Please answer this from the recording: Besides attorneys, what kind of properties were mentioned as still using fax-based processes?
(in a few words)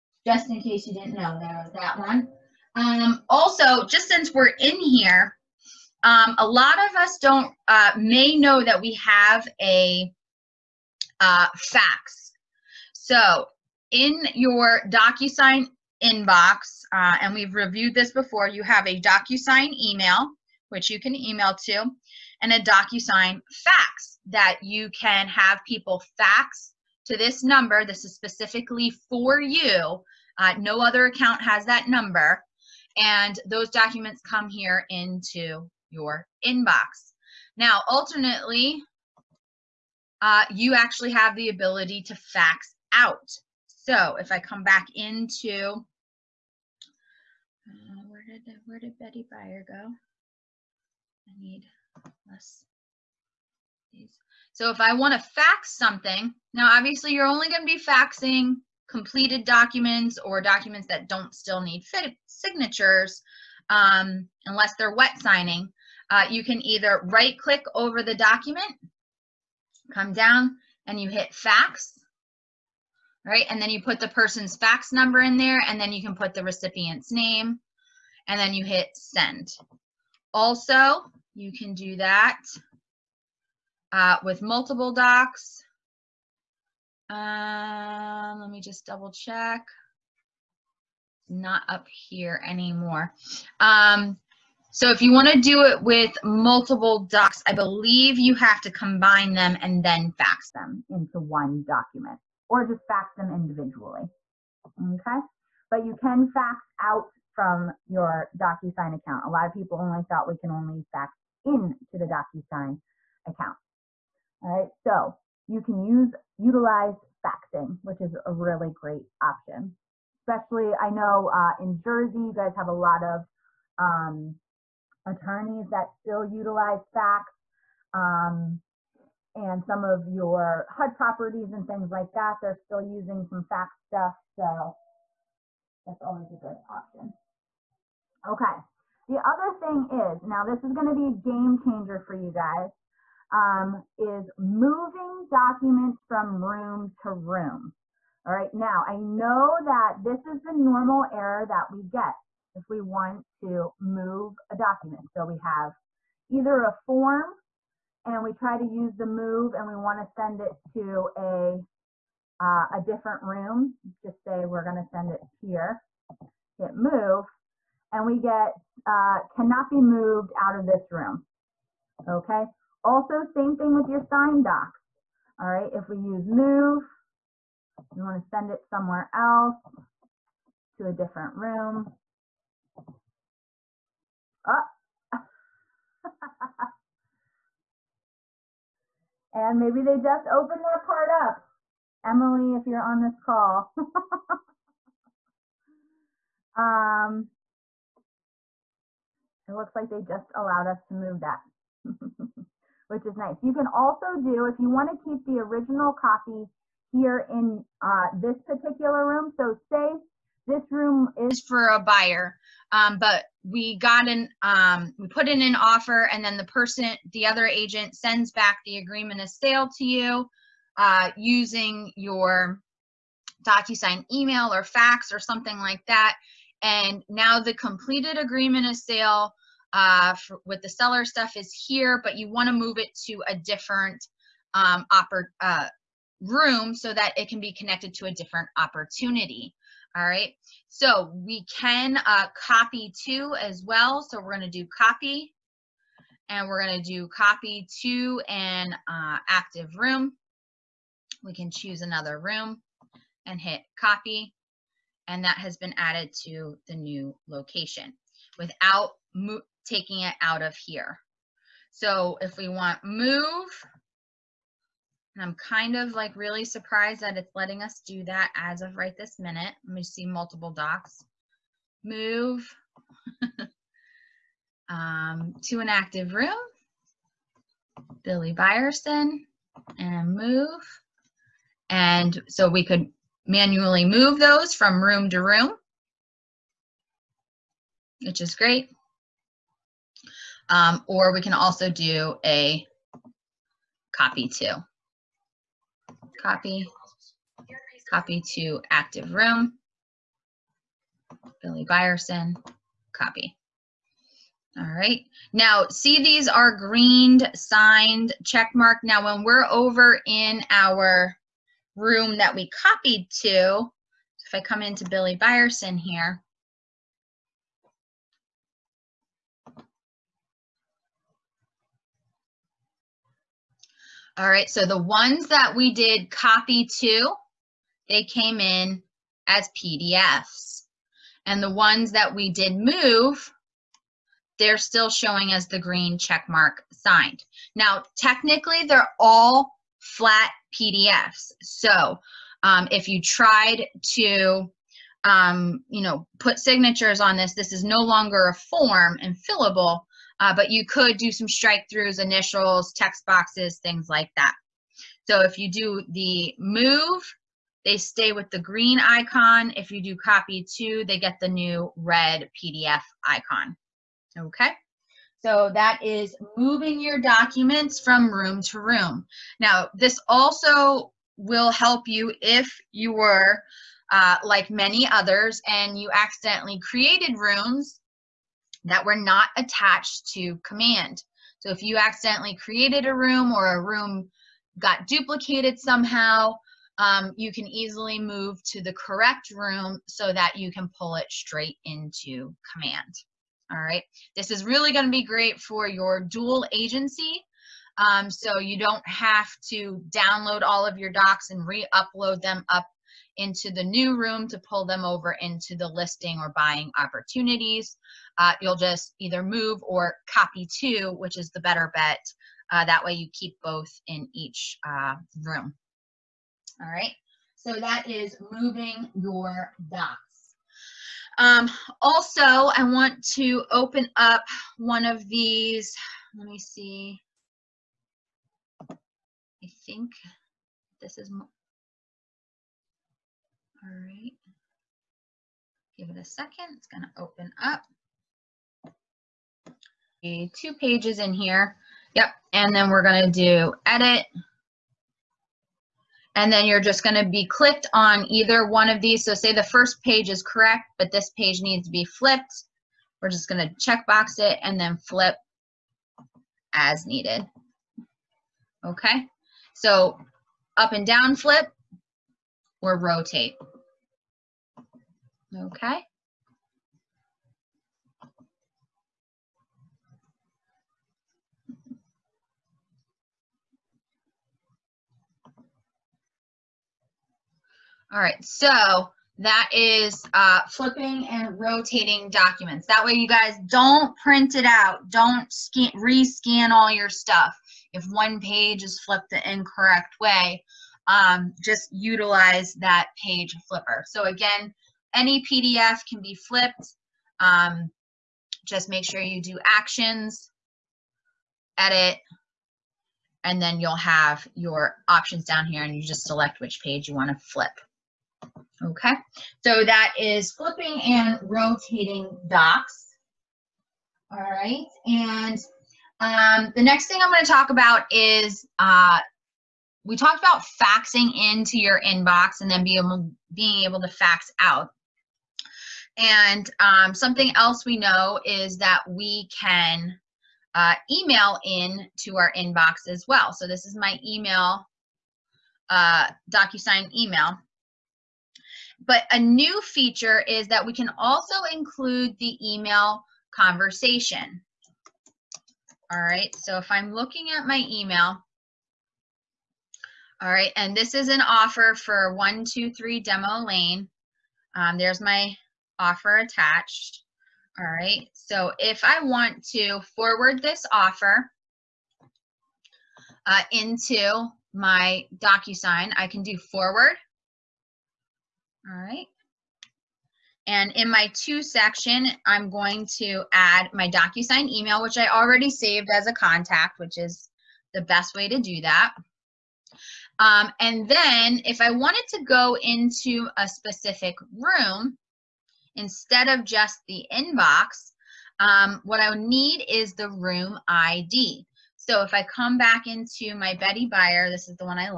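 HUD properties.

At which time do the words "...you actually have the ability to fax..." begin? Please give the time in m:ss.
0:40.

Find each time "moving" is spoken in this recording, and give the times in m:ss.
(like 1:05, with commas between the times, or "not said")
2:24, 6:06, 6:58.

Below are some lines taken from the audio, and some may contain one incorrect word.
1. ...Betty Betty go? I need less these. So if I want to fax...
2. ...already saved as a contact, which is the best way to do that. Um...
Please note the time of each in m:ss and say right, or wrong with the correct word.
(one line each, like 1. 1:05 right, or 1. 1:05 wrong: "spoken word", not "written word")
1. 0:48 wrong: "Buyer", not "Betty"
2. 9:35 right.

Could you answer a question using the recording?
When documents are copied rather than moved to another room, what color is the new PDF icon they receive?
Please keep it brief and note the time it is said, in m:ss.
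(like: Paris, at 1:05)
Red, at 6:01.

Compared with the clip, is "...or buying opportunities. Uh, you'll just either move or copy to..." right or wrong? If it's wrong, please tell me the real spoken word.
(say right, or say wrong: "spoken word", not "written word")
right.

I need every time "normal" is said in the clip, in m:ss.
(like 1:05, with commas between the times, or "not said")
2:30.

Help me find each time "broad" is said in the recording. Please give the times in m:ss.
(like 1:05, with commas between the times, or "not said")
not said.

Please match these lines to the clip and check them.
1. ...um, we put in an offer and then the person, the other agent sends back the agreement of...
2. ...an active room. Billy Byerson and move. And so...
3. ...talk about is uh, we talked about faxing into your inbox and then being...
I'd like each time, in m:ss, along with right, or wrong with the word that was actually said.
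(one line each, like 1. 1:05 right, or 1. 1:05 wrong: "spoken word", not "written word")
1. 3:34 right
2. 4:35 right
3. 8:37 right.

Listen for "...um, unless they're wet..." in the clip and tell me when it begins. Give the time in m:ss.
1:03.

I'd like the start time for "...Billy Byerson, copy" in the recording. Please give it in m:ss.
5:01.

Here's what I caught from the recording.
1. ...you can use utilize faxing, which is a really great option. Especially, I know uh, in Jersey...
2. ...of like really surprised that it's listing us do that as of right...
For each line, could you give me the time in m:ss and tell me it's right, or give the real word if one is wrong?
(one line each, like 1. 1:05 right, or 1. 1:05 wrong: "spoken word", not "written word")
1. 1:55 right
2. 4:25 wrong: "letting", not "listing".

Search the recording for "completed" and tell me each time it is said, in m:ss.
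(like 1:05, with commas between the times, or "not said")
0:58, 3:47.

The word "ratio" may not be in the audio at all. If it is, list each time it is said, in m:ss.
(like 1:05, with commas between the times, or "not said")
not said.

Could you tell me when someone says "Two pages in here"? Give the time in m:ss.
7:20.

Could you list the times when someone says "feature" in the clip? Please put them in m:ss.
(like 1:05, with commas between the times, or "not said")
8:59.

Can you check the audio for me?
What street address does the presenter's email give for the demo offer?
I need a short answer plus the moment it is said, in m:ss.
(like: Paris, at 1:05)
123 Demo Lane, at 9:12.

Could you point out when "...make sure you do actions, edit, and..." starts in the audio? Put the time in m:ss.
8:18.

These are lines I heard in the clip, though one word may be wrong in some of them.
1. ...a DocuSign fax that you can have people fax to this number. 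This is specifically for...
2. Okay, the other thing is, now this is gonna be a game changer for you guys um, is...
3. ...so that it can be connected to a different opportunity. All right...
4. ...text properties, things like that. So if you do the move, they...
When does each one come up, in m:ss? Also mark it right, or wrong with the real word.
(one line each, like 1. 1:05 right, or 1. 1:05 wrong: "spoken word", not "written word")
1. 0:22 right
2. 2:18 right
3. 3:56 right
4. 5:52 wrong: "boxes", not "properties".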